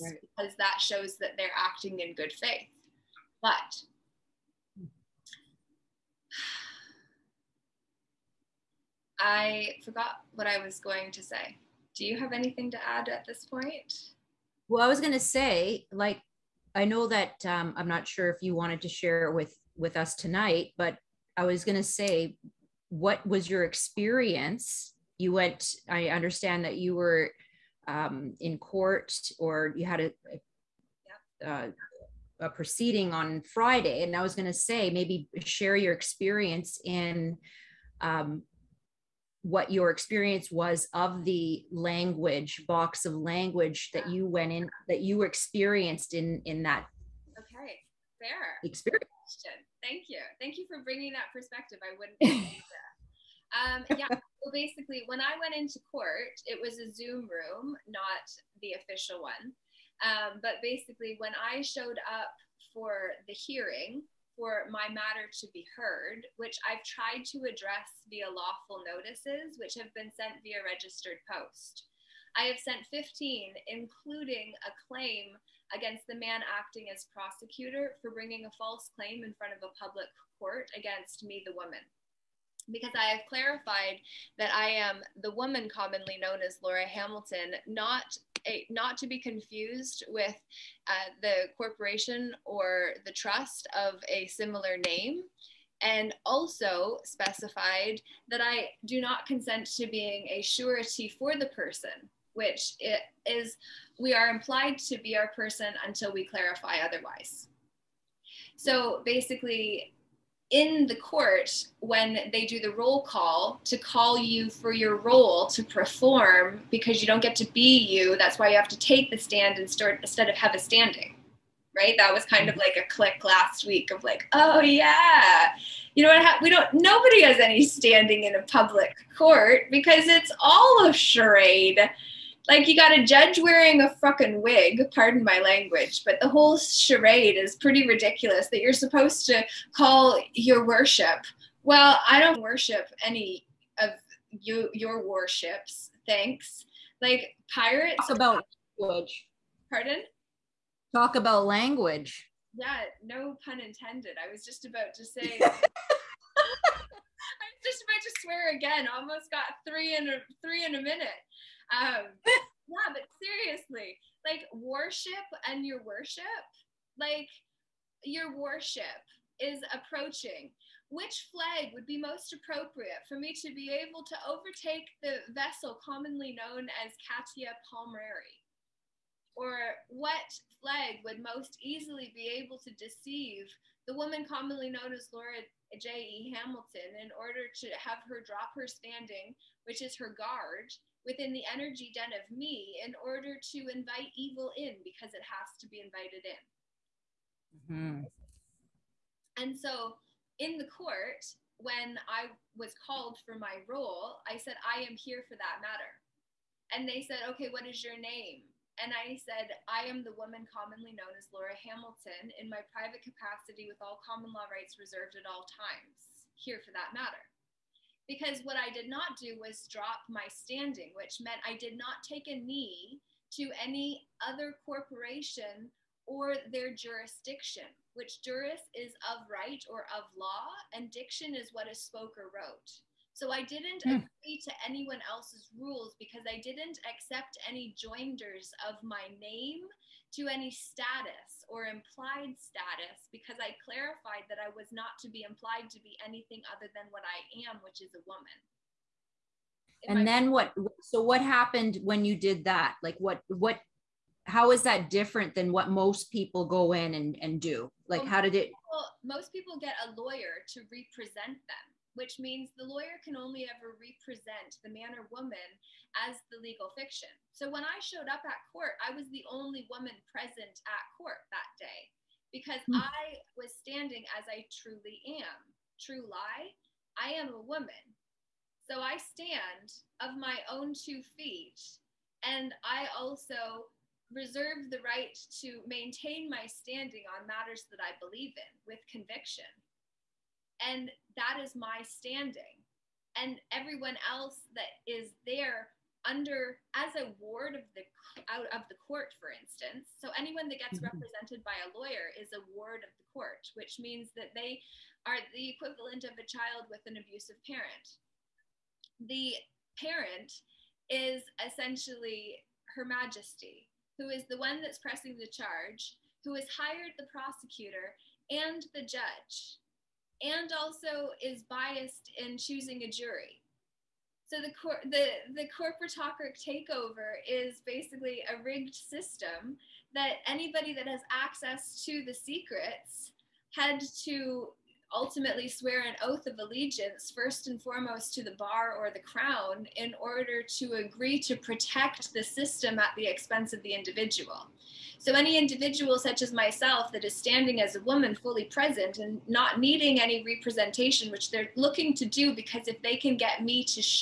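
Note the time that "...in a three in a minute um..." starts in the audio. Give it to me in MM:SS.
02:39.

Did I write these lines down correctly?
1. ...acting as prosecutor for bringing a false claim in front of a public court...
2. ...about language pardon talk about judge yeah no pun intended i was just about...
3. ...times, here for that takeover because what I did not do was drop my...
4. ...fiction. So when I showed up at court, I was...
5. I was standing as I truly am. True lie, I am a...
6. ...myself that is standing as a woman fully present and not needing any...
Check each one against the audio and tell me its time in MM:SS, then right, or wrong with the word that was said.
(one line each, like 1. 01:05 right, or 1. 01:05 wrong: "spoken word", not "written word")
1. 01:16 right
2. 02:28 wrong: "language", not "judge"
3. 03:35 wrong: "matter", not "takeover"
4. 04:26 right
5. 04:32 right
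6. 05:46 right.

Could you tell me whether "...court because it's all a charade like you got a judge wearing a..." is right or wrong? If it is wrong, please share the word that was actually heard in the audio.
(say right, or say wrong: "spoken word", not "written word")
right.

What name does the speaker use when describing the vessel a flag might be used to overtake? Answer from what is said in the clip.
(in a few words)
Katia Palmeri.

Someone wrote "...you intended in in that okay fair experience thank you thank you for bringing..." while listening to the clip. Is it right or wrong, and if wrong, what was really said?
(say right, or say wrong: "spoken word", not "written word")
wrong: "experienced", not "intended".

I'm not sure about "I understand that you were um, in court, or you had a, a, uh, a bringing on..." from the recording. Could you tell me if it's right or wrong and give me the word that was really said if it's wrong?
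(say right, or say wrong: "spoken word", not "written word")
wrong: "proceeding", not "bringing".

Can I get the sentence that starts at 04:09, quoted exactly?
If and I- then what so what happened when you did that?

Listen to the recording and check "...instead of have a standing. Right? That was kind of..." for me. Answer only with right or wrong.
right.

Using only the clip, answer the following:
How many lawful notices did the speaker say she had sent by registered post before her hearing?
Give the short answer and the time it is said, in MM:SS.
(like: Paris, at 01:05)
15, at 01:12.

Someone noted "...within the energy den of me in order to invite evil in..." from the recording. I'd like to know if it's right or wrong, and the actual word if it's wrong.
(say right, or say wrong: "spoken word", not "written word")
right.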